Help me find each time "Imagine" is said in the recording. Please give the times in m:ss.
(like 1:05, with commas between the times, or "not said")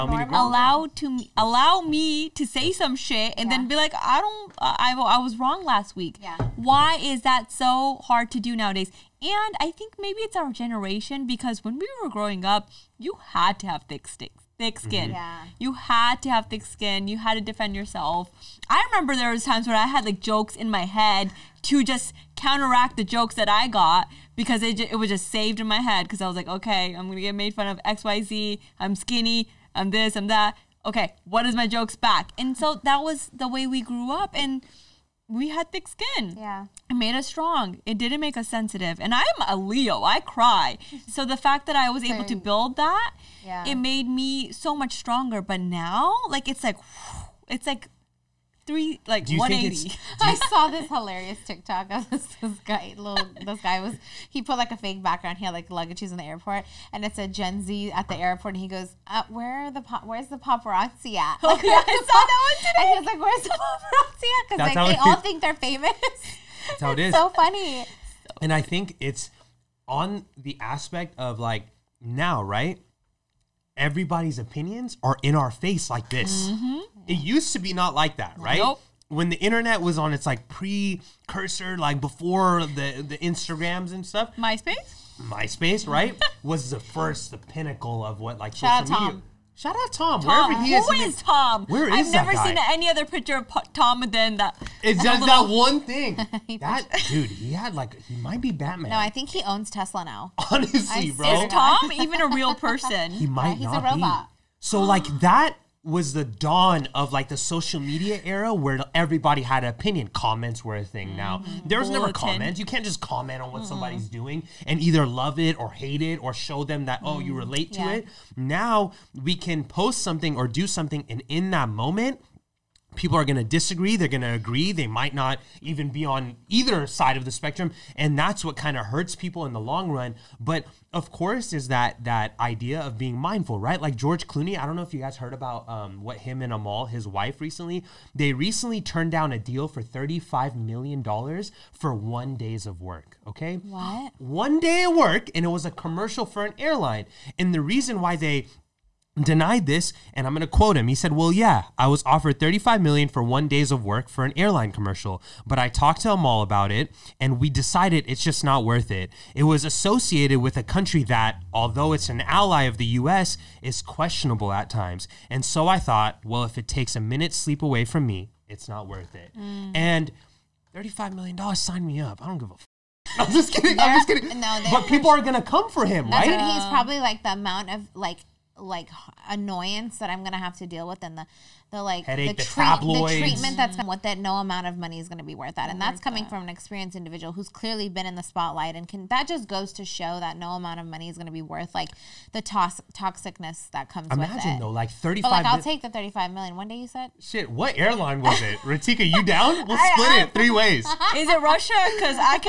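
3:14.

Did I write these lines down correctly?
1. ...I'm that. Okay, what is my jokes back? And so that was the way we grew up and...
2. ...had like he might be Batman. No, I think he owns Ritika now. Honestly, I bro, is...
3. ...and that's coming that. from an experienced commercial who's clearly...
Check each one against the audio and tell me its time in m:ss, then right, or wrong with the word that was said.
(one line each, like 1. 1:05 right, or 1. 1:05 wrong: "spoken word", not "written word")
1. 0:30 right
2. 1:37 wrong: "Tesla", not "Ritika"
3. 3:05 wrong: "individual", not "commercial".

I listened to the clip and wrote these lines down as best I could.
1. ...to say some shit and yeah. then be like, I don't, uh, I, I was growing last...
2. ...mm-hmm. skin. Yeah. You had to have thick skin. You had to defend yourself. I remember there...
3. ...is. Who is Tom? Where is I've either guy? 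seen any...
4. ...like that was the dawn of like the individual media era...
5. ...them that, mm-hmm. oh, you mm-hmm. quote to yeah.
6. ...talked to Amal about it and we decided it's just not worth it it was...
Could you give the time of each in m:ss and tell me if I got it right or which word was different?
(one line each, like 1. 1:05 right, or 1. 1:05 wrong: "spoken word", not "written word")
1. 0:02 wrong: "wrong", not "growing"
2. 0:14 right
3. 1:30 wrong: "never", not "either"
4. 1:44 wrong: "social", not "individual"
5. 1:56 wrong: "relate", not "quote"
6. 2:35 right.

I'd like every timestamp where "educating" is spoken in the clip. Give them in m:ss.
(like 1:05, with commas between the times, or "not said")
not said.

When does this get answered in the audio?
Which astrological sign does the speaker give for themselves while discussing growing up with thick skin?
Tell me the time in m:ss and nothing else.
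0:39.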